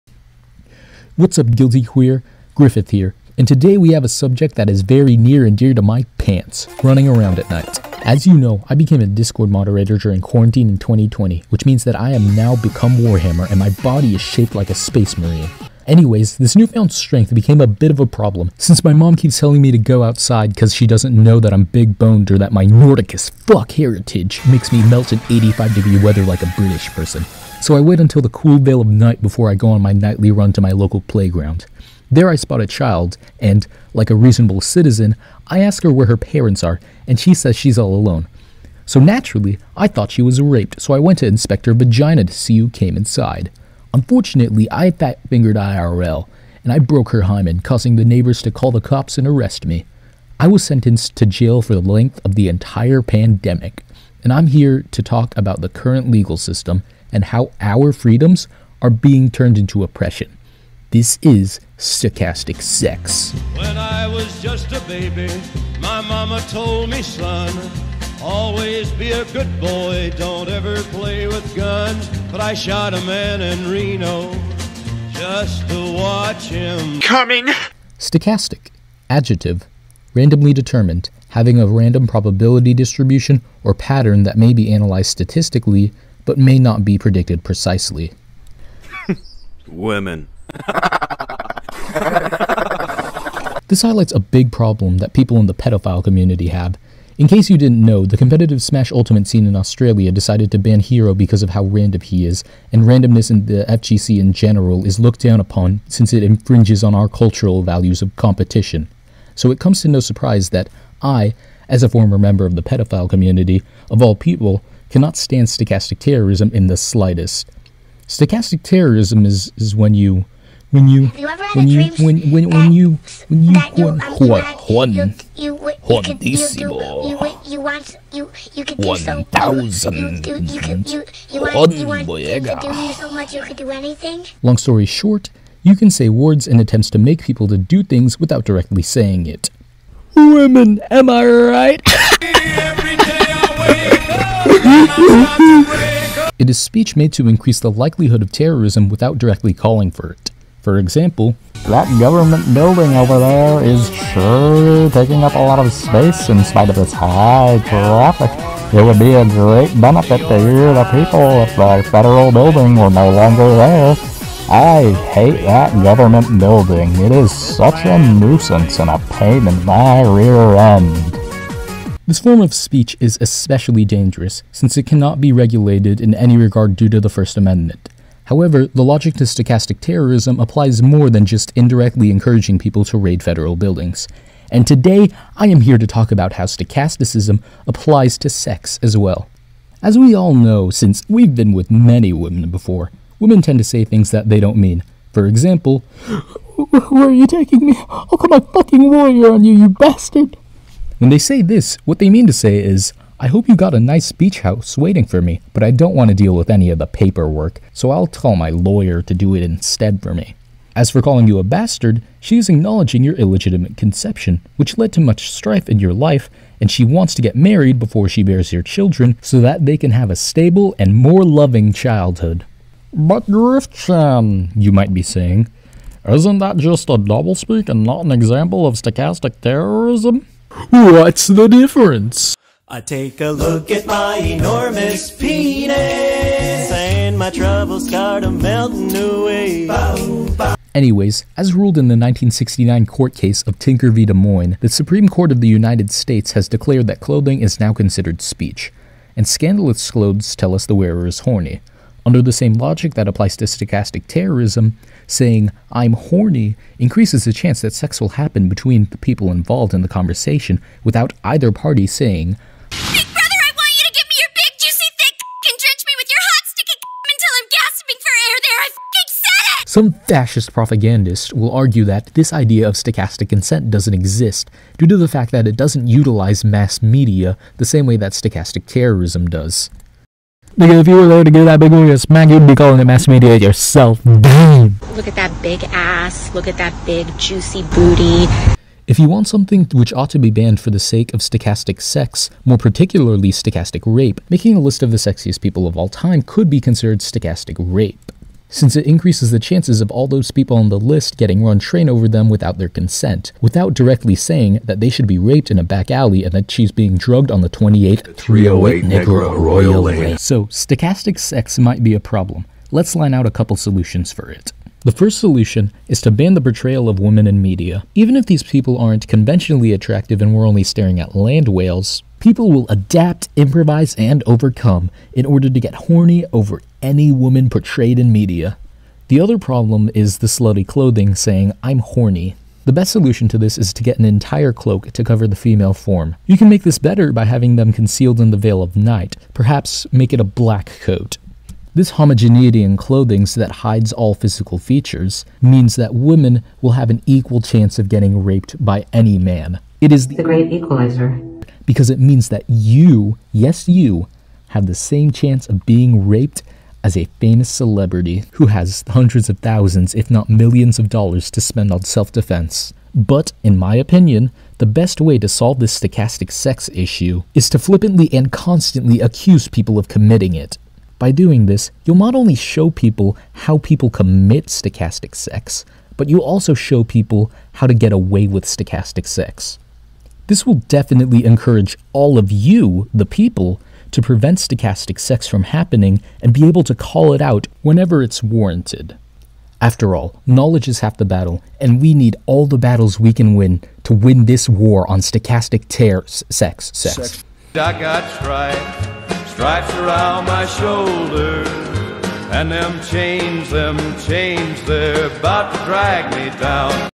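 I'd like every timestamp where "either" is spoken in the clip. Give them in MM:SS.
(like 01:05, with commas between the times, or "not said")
04:21.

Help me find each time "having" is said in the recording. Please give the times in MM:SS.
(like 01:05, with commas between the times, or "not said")
01:21, 05:37.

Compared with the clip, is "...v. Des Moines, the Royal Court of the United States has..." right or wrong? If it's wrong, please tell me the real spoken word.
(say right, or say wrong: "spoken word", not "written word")
wrong: "Supreme", not "Royal".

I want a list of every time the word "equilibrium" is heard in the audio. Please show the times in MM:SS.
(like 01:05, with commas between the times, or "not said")
not said.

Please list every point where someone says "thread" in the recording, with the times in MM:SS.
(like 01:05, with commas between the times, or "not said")
not said.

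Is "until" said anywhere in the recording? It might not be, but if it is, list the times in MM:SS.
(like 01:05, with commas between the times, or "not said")
00:27, 04:27.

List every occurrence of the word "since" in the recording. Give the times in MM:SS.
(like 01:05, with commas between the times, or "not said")
00:18, 01:45, 02:54, 03:10, 04:58.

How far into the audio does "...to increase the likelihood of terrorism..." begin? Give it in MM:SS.
02:27.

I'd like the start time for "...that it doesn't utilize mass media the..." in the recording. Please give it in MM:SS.
04:35.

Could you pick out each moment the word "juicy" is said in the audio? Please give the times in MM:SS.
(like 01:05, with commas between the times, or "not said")
04:24, 04:47.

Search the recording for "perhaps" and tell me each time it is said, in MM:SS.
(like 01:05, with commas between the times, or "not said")
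05:39.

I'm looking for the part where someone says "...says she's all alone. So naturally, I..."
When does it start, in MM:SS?
00:37.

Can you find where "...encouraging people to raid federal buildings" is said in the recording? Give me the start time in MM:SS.
03:02.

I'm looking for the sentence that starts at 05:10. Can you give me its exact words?
So, stochastic sex might be a problem.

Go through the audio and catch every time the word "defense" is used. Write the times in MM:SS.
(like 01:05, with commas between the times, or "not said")
06:02.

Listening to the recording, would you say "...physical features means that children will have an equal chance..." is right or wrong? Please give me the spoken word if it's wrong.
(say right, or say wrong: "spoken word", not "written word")
wrong: "women", not "children".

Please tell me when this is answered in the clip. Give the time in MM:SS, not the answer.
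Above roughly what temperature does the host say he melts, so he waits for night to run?
00:25.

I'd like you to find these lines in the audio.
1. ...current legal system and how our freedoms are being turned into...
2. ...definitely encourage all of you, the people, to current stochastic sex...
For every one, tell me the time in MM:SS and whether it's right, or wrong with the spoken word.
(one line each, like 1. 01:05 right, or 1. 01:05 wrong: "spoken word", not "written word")
1. 00:55 right
2. 06:20 wrong: "prevent", not "current".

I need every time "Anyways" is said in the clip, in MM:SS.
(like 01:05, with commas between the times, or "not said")
00:15, 04:00.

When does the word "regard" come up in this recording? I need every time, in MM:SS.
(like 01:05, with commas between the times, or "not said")
02:56.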